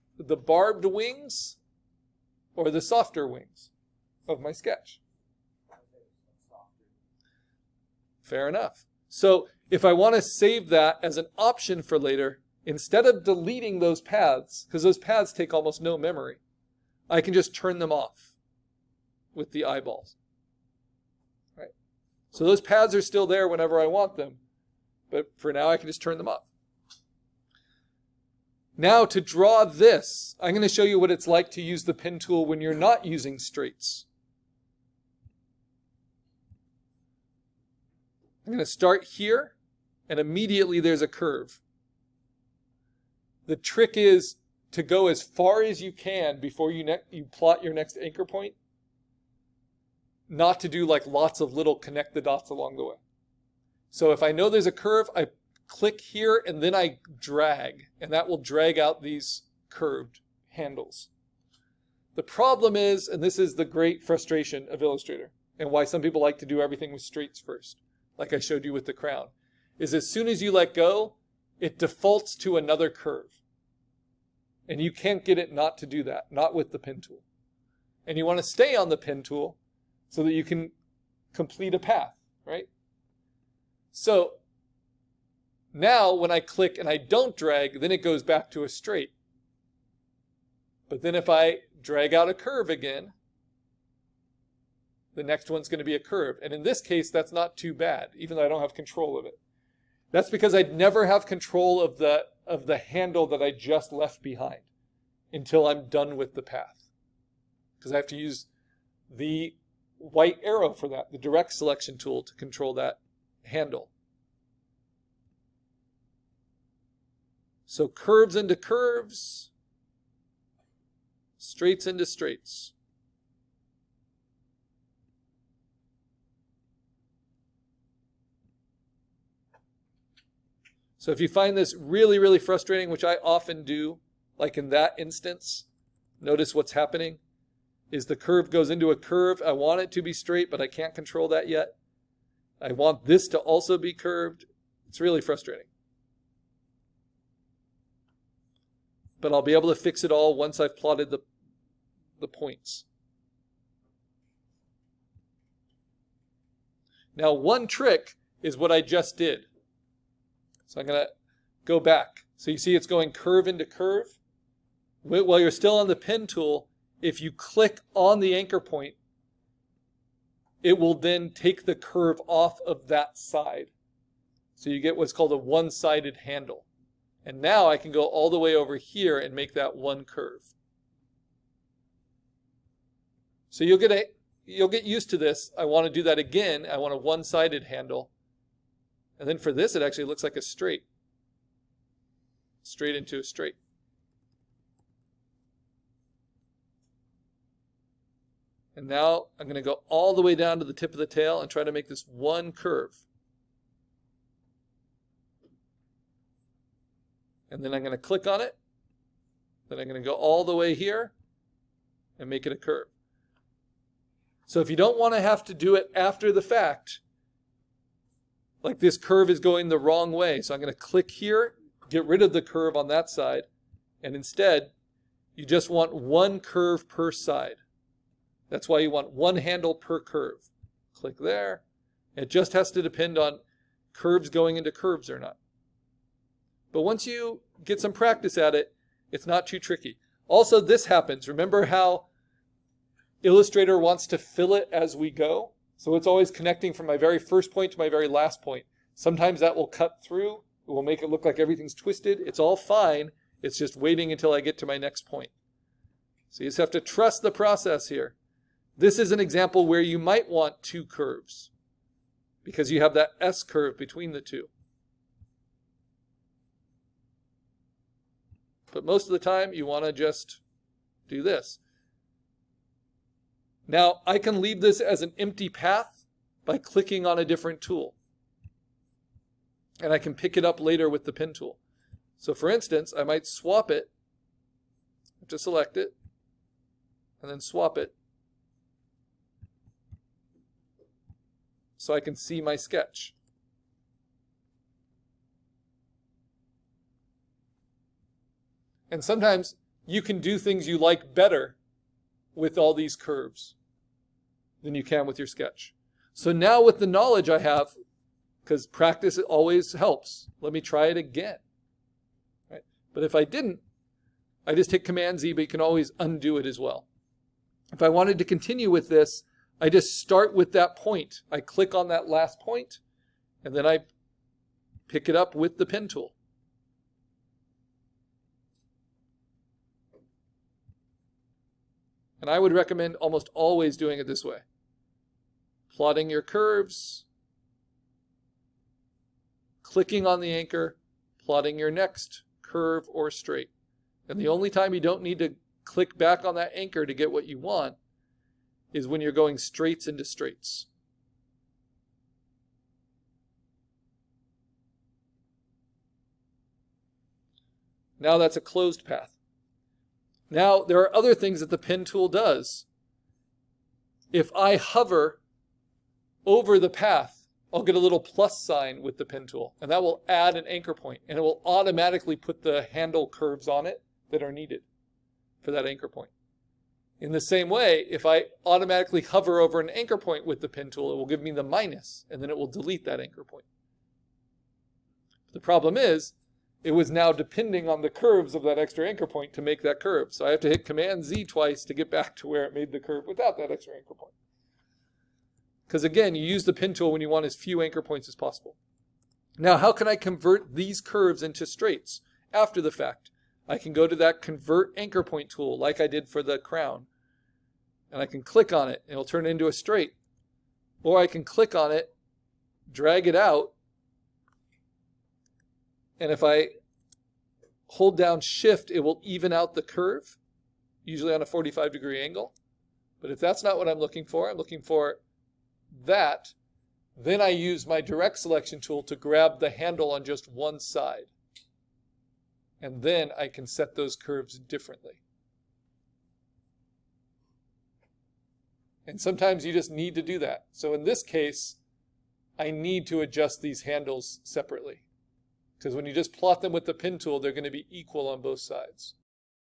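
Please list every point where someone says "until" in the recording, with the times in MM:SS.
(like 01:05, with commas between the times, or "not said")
01:45, 04:14.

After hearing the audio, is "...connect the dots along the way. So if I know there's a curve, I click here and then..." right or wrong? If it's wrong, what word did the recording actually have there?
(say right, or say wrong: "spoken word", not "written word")
right.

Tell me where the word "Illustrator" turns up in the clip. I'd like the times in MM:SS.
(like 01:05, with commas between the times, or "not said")
01:04, 04:03.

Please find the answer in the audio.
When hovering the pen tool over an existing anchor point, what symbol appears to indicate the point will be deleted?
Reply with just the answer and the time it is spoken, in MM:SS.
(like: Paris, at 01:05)
the minus, at 06:21.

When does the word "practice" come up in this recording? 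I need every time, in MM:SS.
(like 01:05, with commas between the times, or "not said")
03:57, 05:08.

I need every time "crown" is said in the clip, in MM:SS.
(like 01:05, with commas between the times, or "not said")
01:08, 06:46.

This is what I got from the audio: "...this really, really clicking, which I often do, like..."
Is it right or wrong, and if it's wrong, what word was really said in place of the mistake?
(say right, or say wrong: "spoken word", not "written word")
wrong: "frustrating", not "clicking".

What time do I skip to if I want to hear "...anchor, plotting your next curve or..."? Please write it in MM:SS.
05:40.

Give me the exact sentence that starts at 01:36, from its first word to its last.
And in this case, that's not too bad, even though I don't have control of it.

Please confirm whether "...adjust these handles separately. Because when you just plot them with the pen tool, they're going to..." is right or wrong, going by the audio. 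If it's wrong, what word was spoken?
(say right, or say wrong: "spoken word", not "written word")
right.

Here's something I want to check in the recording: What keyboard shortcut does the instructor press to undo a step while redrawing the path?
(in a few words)
Command Z.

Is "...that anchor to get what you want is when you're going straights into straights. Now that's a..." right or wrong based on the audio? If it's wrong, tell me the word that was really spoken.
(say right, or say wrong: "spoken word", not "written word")
right.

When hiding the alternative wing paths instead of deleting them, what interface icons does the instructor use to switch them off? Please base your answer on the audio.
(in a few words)
the eyeballs.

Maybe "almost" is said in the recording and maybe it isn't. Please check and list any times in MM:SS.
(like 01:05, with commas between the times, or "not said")
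00:15, 05:32.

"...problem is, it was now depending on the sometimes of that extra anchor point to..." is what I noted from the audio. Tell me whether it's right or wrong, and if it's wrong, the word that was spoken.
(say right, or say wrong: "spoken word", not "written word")
wrong: "curves", not "sometimes".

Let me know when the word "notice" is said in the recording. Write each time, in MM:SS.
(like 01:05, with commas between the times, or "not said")
02:16.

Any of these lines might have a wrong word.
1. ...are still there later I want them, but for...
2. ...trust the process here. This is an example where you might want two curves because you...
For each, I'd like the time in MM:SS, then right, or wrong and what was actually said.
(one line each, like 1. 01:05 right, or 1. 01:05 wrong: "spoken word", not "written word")
1. 00:22 wrong: "whenever", not "later"
2. 04:16 right.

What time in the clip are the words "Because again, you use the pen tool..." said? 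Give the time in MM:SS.
06:35.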